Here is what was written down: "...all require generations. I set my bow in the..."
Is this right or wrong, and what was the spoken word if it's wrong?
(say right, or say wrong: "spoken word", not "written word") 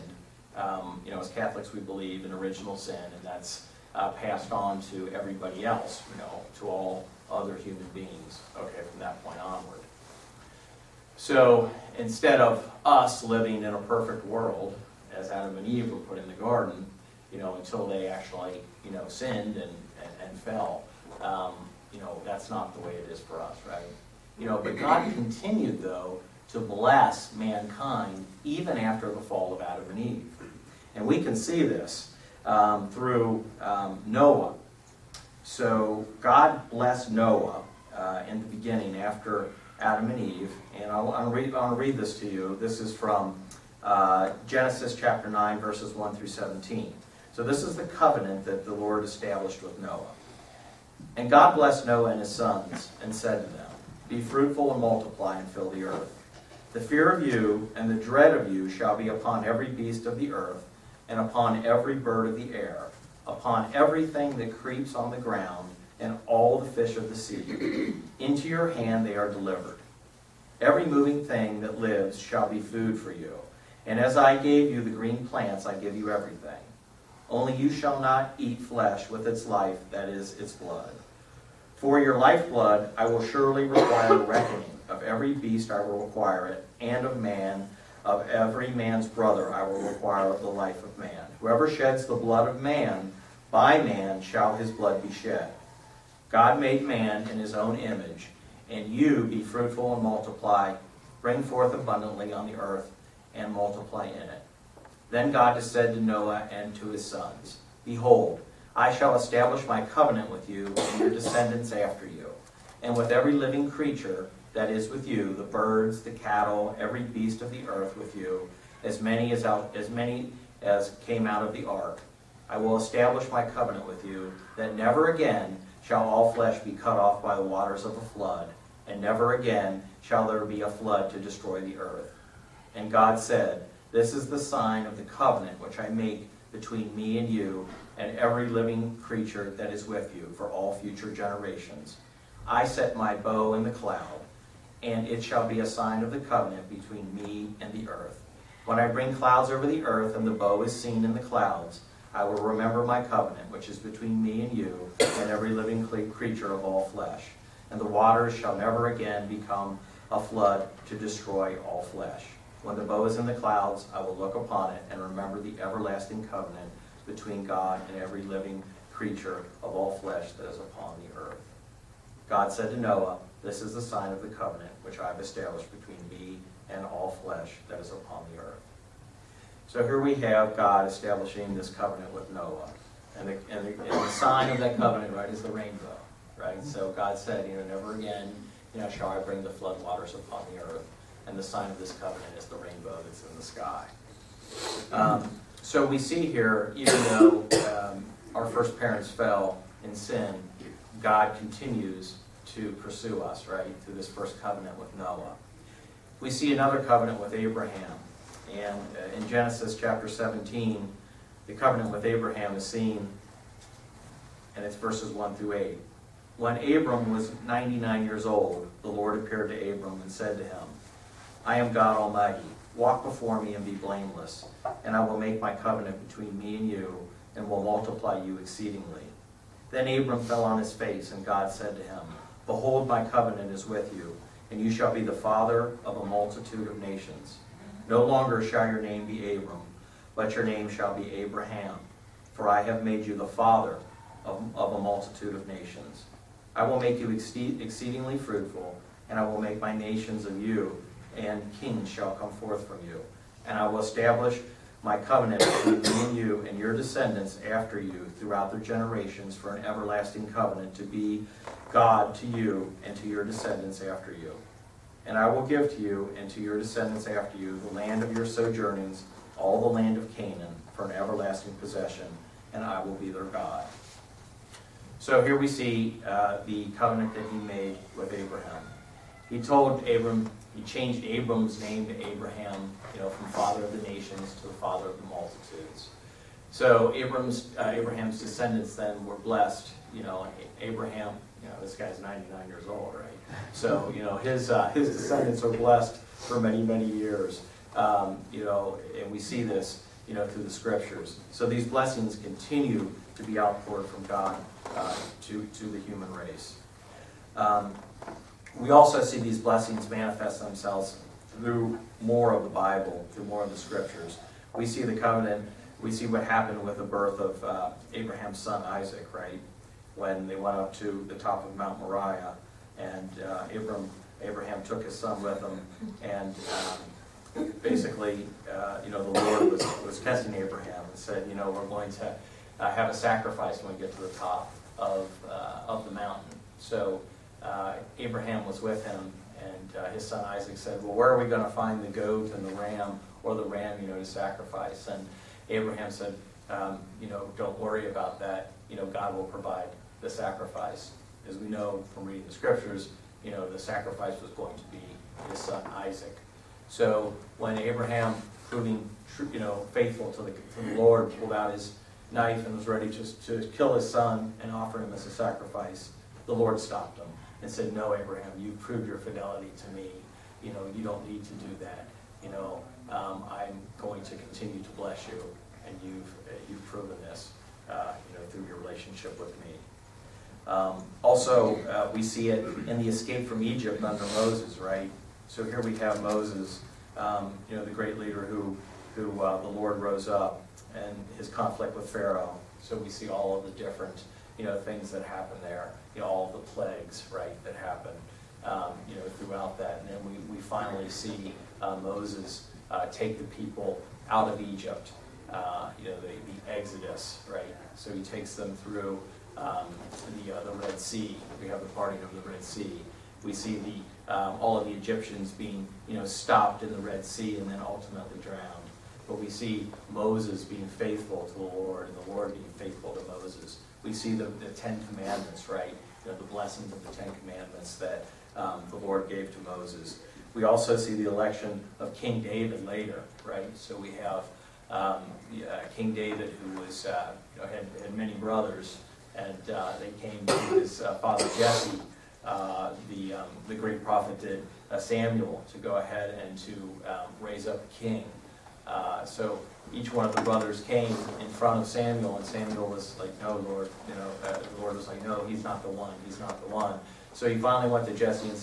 wrong: "future", not "require".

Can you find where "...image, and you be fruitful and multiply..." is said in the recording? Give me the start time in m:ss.
1:37.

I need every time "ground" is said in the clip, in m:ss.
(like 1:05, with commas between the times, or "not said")
1:05.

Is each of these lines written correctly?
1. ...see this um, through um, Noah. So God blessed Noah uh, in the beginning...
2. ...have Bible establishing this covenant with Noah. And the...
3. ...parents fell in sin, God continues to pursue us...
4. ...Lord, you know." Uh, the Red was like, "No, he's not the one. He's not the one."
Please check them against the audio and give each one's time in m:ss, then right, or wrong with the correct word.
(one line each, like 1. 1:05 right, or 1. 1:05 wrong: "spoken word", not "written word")
1. 0:31 right
2. 3:00 wrong: "God", not "Bible"
3. 3:18 right
4. 7:33 wrong: "Lord", not "Red".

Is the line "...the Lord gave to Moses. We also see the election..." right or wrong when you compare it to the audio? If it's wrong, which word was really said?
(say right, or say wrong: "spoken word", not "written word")
right.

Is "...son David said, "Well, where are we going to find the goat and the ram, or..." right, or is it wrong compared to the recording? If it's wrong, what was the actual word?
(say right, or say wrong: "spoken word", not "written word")
wrong: "Isaac", not "David".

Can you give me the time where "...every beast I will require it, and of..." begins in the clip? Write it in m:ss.
1:25.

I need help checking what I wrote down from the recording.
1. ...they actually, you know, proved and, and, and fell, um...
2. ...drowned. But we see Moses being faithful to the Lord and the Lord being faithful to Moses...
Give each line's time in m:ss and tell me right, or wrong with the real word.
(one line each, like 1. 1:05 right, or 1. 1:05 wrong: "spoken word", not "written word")
1. 0:17 wrong: "sinned", not "proved"
2. 6:58 right.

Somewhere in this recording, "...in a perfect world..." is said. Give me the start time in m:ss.
0:13.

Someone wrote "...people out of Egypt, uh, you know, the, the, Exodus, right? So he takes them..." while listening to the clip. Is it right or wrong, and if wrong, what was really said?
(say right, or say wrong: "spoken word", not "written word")
right.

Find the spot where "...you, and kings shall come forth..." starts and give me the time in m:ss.
4:10.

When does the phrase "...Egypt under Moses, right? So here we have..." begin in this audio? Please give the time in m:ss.
6:23.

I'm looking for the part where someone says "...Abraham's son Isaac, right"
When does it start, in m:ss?
5:17.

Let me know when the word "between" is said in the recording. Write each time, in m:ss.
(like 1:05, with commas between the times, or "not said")
2:16, 2:26, 2:33, 2:47, 2:55, 3:46, 4:15.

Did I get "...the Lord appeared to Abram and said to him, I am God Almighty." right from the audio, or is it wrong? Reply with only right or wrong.
right.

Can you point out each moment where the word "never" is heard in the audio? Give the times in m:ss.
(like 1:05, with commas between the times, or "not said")
2:04, 2:08, 2:38, 3:07.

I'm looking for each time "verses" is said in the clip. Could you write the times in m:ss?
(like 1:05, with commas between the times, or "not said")
0:45, 3:34.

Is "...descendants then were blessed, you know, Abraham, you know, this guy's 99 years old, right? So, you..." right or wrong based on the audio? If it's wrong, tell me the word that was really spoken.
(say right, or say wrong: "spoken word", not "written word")
right.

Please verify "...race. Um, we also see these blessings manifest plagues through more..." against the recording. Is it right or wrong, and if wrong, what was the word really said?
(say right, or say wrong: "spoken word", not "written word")
wrong: "themselves", not "plagues".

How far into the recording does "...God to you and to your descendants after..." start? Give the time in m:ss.
4:21.